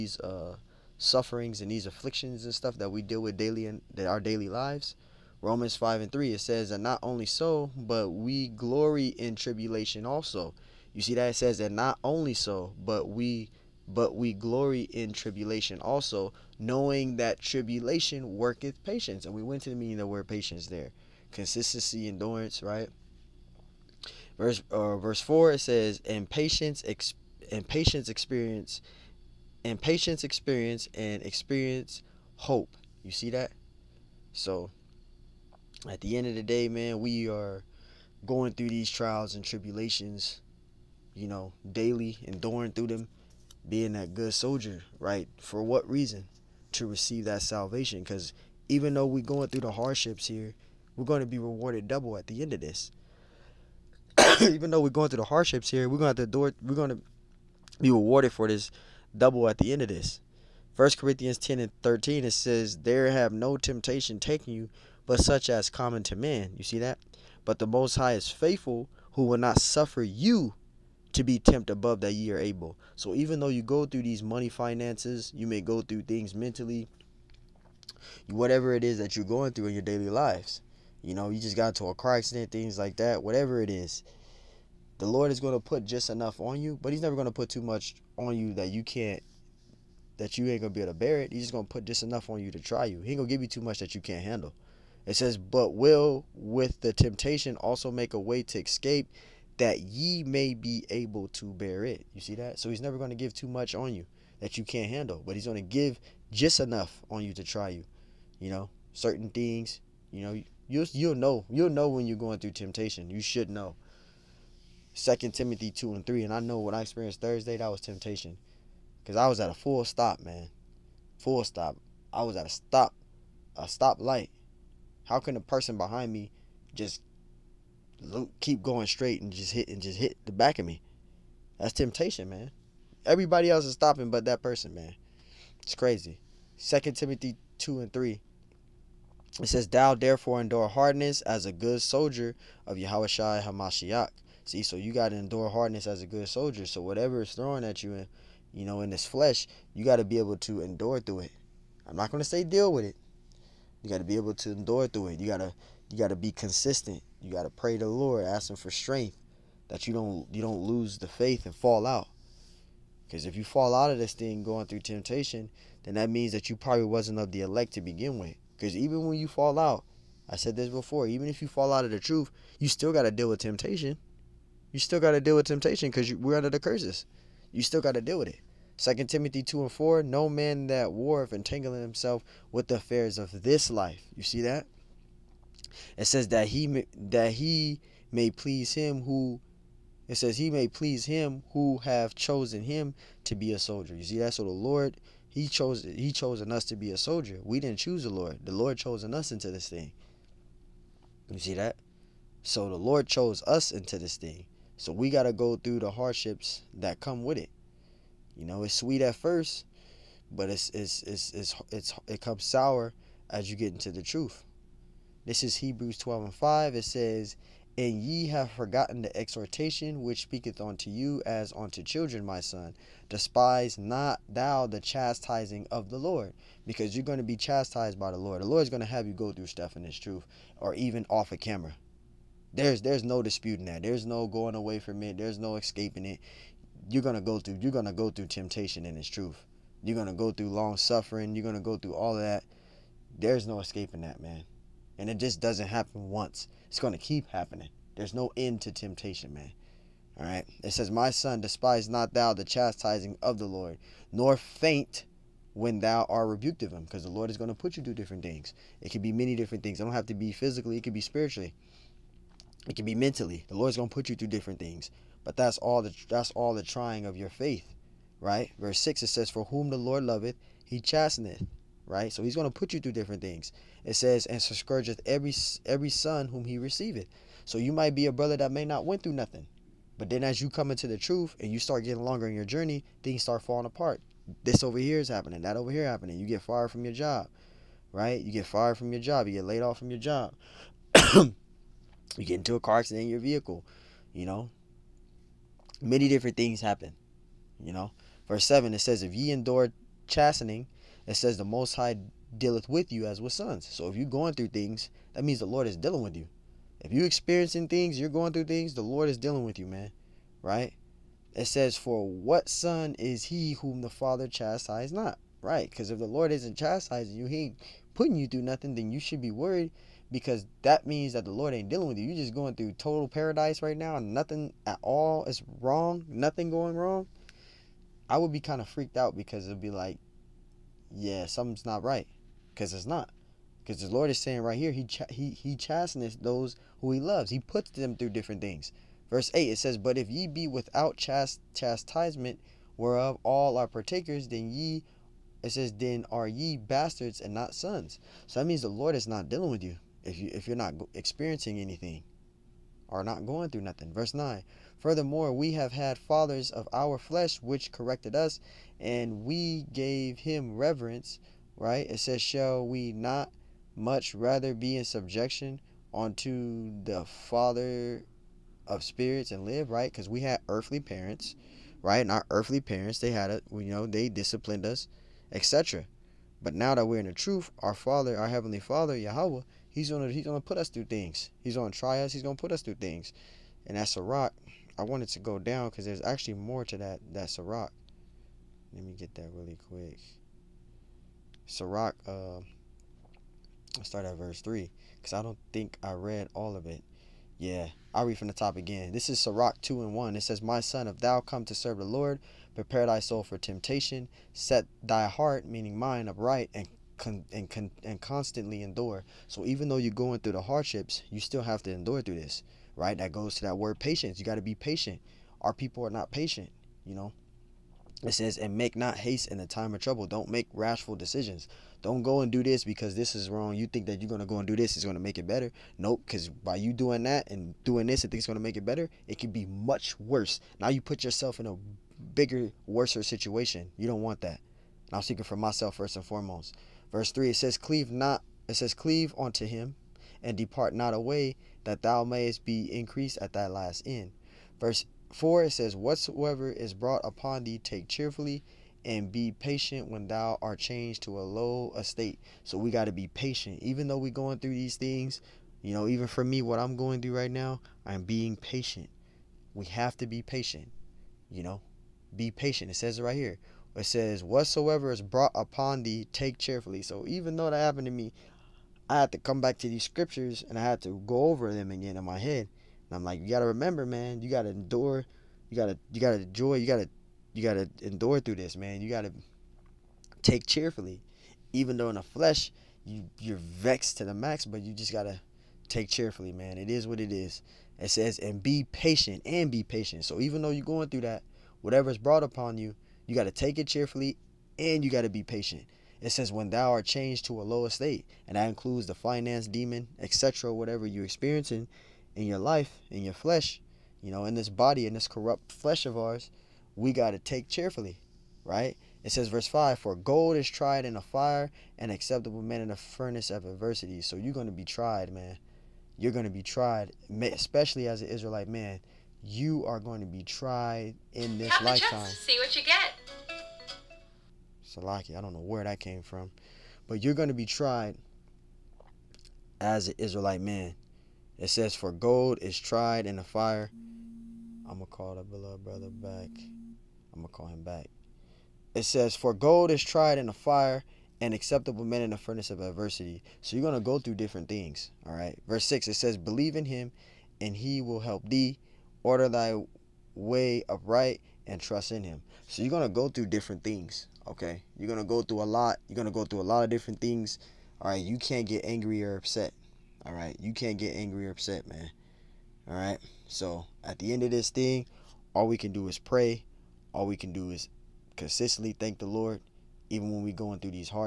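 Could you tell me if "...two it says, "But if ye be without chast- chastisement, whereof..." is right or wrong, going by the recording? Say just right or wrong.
wrong.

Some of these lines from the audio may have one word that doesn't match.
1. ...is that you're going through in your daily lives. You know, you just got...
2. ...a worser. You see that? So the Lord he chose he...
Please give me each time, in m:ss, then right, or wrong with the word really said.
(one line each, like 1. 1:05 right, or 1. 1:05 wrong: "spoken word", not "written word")
1. 1:18 right
2. 3:13 wrong: "soldier", not "worser".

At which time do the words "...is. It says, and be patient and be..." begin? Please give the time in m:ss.
8:07.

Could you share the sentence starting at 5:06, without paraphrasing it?
If you're experiencing things, you're going through things, the Lord is dealing with you, man.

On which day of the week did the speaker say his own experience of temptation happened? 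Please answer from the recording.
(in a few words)
Thursday.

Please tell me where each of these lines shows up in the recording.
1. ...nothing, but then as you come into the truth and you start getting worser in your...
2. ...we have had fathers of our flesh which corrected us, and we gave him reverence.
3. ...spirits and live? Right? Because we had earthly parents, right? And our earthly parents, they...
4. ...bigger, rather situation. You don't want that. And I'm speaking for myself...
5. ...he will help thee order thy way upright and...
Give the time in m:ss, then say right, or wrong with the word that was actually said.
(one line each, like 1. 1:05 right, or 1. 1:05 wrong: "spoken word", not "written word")
1. 4:39 wrong: "longer", not "worser"
2. 5:55 right
3. 6:08 right
4. 7:12 wrong: "worser", not "rather"
5. 9:07 right.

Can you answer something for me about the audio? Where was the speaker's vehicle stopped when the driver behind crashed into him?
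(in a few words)
A stoplight.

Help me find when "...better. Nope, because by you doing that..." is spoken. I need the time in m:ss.
7:05.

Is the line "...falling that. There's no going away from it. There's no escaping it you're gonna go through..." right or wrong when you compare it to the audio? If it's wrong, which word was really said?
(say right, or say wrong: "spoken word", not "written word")
wrong: "disputing", not "falling".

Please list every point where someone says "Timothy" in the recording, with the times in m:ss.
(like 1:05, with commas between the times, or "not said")
1:55, 2:16, 2:59.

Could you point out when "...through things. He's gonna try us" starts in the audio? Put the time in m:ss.
6:20.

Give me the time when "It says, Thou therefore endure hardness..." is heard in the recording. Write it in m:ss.
2:19.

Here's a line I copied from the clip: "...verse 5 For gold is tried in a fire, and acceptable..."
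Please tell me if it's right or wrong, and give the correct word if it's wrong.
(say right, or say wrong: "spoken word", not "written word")
right.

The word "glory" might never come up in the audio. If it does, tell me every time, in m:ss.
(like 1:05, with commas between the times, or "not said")
0:08, 0:14.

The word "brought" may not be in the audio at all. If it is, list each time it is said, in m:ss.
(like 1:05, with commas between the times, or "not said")
7:26, 7:45, 8:11.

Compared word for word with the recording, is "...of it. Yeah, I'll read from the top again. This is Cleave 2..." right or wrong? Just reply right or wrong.
wrong.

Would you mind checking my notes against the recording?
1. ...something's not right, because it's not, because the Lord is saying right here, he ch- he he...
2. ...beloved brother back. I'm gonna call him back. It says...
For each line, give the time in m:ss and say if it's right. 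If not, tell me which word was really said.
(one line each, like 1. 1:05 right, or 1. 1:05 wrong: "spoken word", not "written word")
1. 5:31 right
2. 8:55 right.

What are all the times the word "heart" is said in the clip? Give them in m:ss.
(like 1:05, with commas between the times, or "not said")
6:45.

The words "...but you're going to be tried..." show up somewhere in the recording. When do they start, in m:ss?
8:46.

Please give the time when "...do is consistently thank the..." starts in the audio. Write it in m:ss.
9:27.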